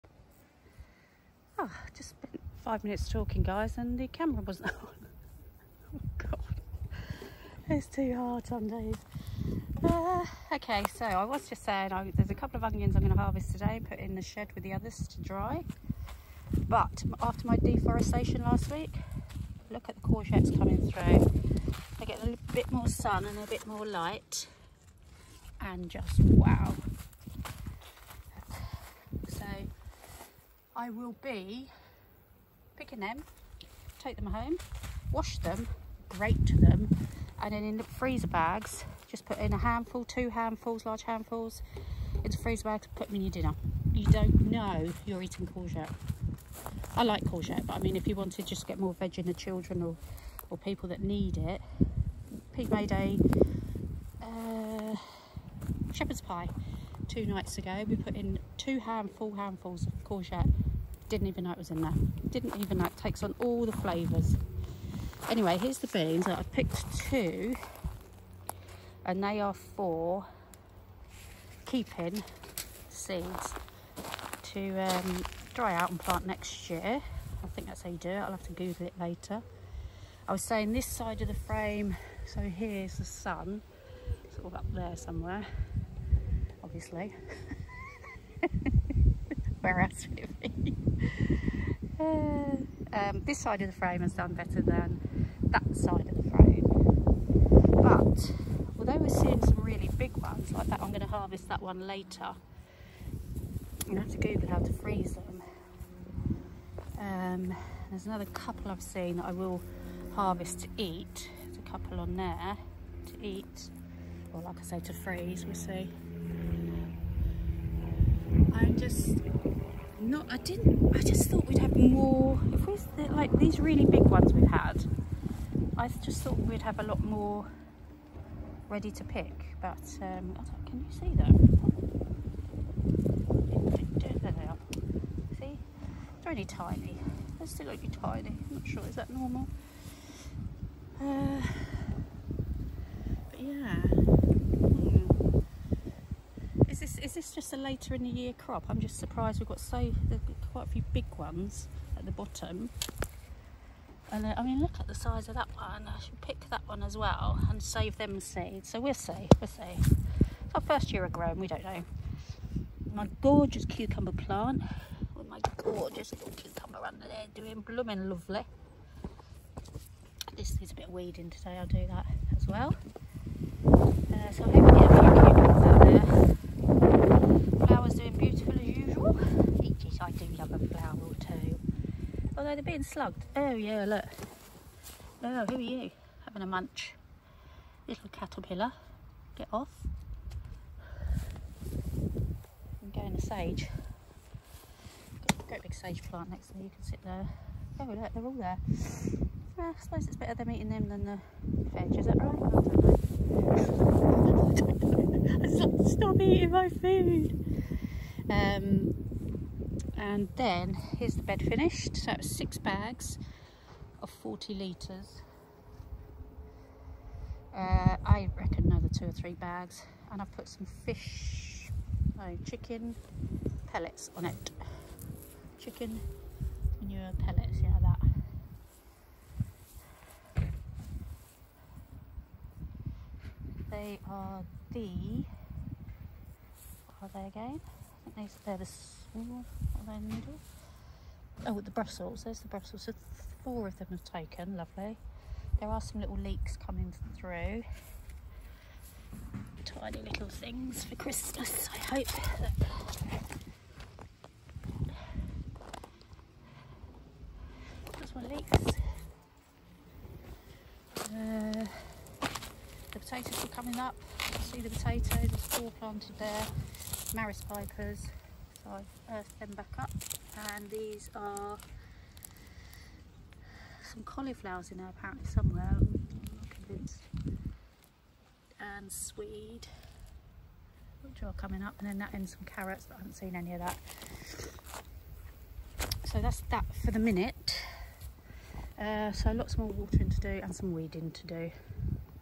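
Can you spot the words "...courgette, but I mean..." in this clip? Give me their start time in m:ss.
0:47.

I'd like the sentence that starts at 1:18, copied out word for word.
I'll have to Google it later.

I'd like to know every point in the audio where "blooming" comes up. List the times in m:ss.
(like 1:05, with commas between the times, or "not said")
2:47.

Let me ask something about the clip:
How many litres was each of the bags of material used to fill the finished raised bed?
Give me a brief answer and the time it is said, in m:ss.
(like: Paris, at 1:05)
40 litres, at 3:34.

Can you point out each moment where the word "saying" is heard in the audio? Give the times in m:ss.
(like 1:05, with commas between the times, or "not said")
0:11, 1:20.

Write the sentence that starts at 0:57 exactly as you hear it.
We put in two handful handfuls of courgette didn't even know it was in there.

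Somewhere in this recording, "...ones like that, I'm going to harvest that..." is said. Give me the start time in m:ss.
1:40.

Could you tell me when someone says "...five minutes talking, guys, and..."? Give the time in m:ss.
0:02.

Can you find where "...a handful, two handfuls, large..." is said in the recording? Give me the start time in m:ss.
0:39.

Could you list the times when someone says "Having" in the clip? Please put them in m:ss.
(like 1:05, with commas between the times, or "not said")
3:06.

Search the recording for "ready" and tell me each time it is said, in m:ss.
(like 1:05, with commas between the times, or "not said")
2:08.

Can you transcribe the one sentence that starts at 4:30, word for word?
And these are some cauliflowers in there apparently somewhere.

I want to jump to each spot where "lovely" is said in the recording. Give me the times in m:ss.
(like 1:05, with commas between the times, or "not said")
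2:48, 4:04.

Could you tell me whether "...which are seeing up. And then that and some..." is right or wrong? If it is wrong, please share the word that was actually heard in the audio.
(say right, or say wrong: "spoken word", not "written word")
wrong: "coming", not "seeing".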